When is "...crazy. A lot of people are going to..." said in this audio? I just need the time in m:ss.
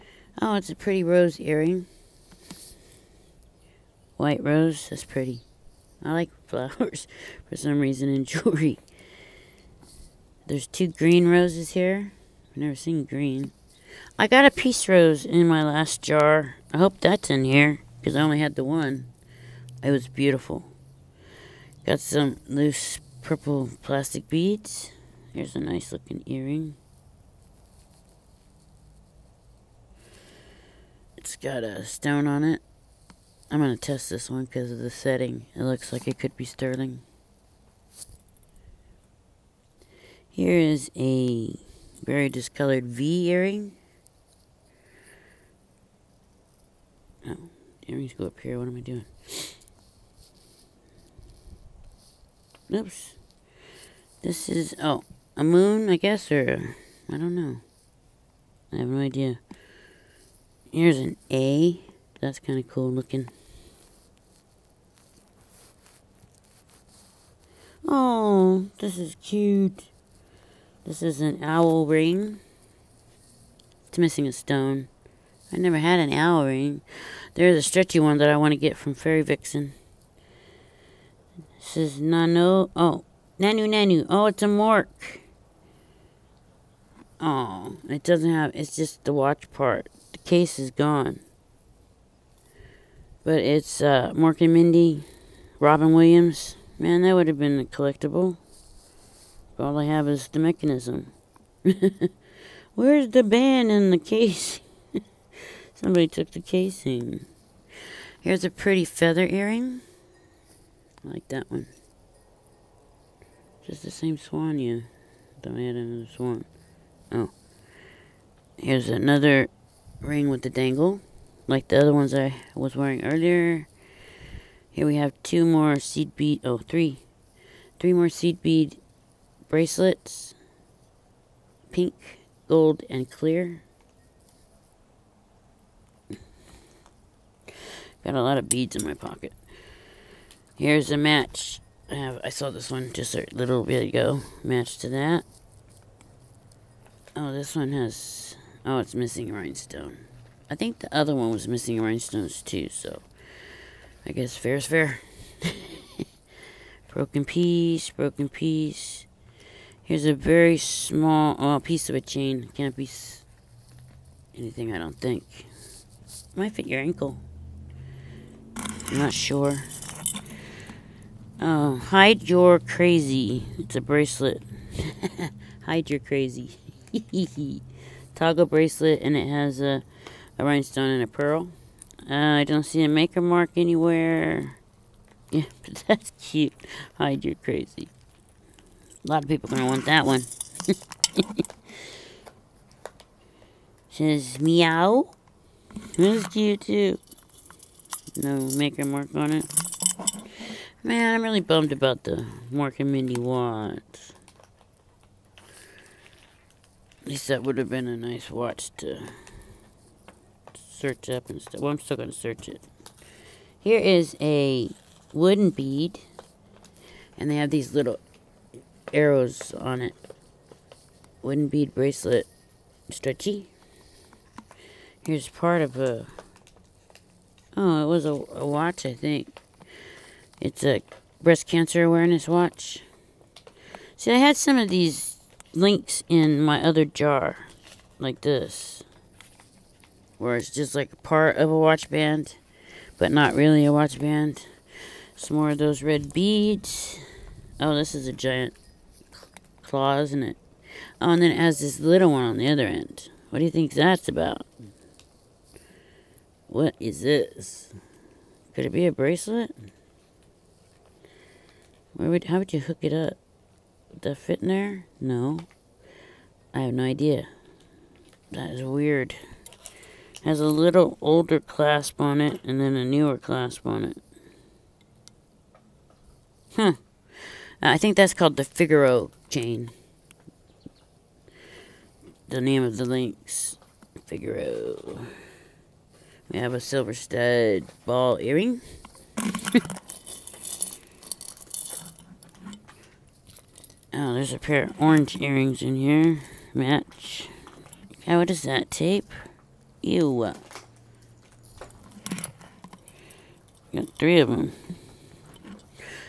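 3:07.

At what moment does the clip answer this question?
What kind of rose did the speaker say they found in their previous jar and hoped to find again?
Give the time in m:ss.
0:14.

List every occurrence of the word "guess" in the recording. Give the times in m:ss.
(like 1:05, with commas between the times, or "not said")
0:55, 2:34.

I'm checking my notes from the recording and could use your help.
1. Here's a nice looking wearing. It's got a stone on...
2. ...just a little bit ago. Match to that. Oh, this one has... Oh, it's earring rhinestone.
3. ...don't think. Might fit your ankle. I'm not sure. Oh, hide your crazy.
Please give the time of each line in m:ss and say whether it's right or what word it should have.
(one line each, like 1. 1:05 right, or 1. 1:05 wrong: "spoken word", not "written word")
1. 0:25 wrong: "earring", not "wearing"
2. 2:22 wrong: "missing", not "earring"
3. 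2:44 right.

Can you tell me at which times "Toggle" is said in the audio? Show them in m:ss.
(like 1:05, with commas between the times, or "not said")
2:58.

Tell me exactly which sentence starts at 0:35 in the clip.
It looks like it could be sterling.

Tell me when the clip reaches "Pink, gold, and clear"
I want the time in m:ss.
2:11.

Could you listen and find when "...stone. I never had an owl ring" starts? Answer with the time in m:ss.
1:14.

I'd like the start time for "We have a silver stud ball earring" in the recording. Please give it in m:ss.
4:46.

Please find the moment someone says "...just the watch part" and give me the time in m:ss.
1:28.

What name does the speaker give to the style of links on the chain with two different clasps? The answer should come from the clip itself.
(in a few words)
Figaro chain.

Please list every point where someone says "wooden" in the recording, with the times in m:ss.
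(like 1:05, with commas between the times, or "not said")
3:35, 3:41.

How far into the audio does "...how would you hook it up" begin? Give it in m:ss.
4:22.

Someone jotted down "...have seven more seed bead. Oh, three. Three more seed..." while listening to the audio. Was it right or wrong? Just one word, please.
wrong.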